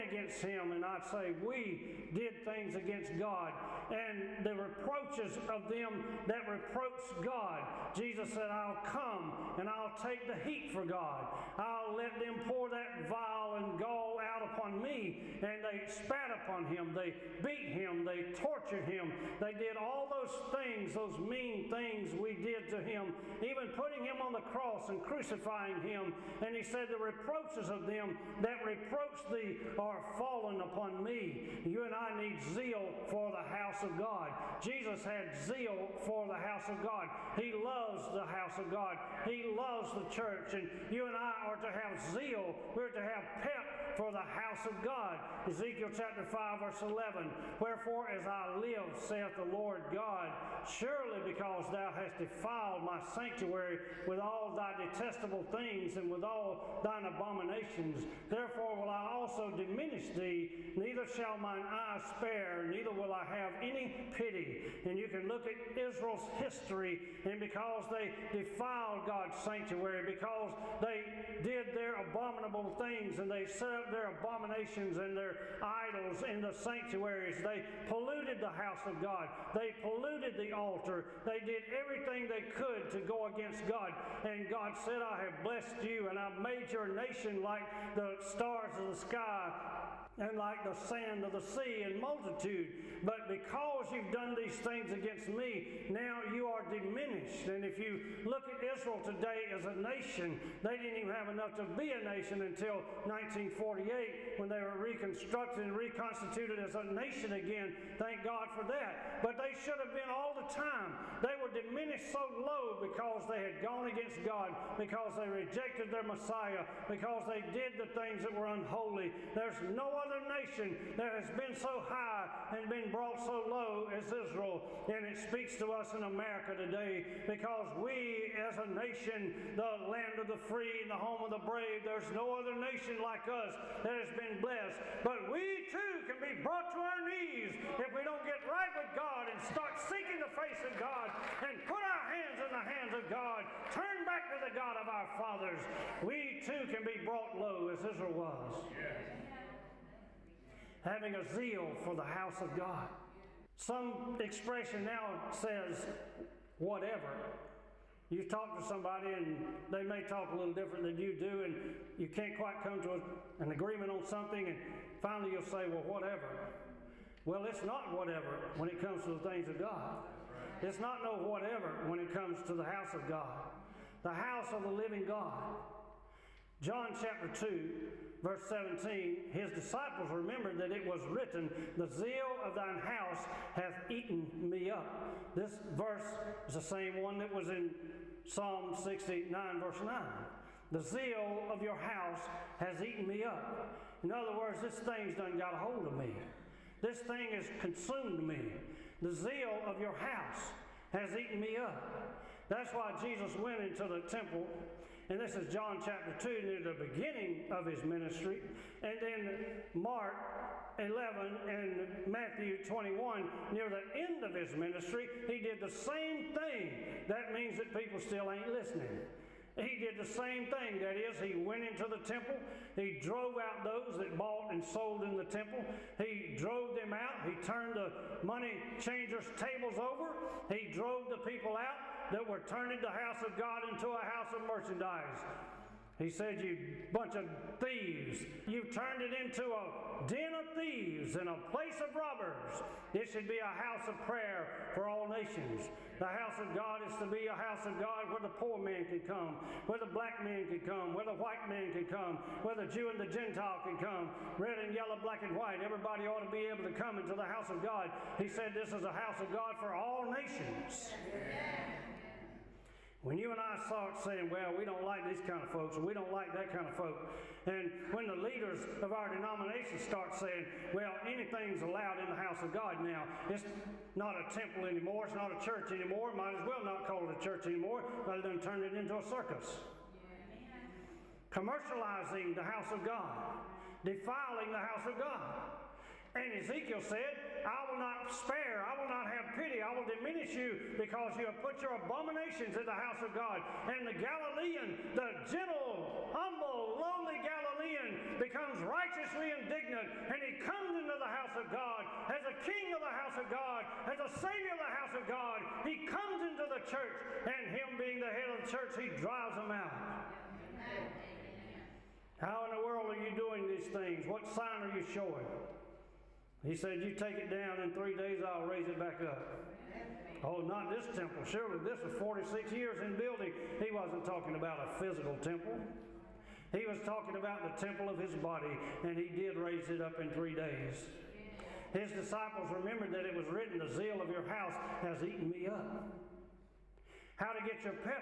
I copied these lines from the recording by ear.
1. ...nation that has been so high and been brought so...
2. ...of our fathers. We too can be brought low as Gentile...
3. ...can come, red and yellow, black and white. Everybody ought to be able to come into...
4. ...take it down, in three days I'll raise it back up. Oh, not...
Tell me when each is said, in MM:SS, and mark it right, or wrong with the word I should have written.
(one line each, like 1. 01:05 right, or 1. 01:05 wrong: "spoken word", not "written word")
1. 02:00 right
2. 02:24 wrong: "Israel", not "Gentile"
3. 04:13 right
4. 05:16 right.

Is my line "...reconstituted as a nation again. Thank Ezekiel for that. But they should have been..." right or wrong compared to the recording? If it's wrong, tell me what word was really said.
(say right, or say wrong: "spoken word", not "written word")
wrong: "God", not "Ezekiel".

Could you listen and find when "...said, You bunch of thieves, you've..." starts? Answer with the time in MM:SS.
03:56.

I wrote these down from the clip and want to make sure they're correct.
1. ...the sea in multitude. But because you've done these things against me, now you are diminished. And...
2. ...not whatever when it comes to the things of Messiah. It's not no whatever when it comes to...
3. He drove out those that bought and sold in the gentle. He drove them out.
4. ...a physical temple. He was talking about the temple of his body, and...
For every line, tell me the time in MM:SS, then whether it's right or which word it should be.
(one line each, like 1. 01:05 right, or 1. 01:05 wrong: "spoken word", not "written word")
1. 01:31 right
2. 02:47 wrong: "God", not "Messiah"
3. 03:42 wrong: "temple", not "gentle"
4. 05:24 right.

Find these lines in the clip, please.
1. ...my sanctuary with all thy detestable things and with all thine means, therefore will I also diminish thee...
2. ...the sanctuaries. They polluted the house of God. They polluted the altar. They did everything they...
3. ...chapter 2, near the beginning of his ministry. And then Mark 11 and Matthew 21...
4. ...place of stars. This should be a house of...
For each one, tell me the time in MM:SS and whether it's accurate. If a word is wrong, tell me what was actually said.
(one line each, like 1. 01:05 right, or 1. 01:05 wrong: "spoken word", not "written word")
1. 00:52 wrong: "abominations", not "means"
2. 01:16 right
3. 03:25 right
4. 04:01 wrong: "robbers", not "stars".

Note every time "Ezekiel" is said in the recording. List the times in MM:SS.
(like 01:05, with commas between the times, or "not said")
00:45, 04:46.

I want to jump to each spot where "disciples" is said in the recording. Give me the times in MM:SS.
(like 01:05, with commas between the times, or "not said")
02:59, 05:31.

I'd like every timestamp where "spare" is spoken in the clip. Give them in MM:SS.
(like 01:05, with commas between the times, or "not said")
01:02, 04:48.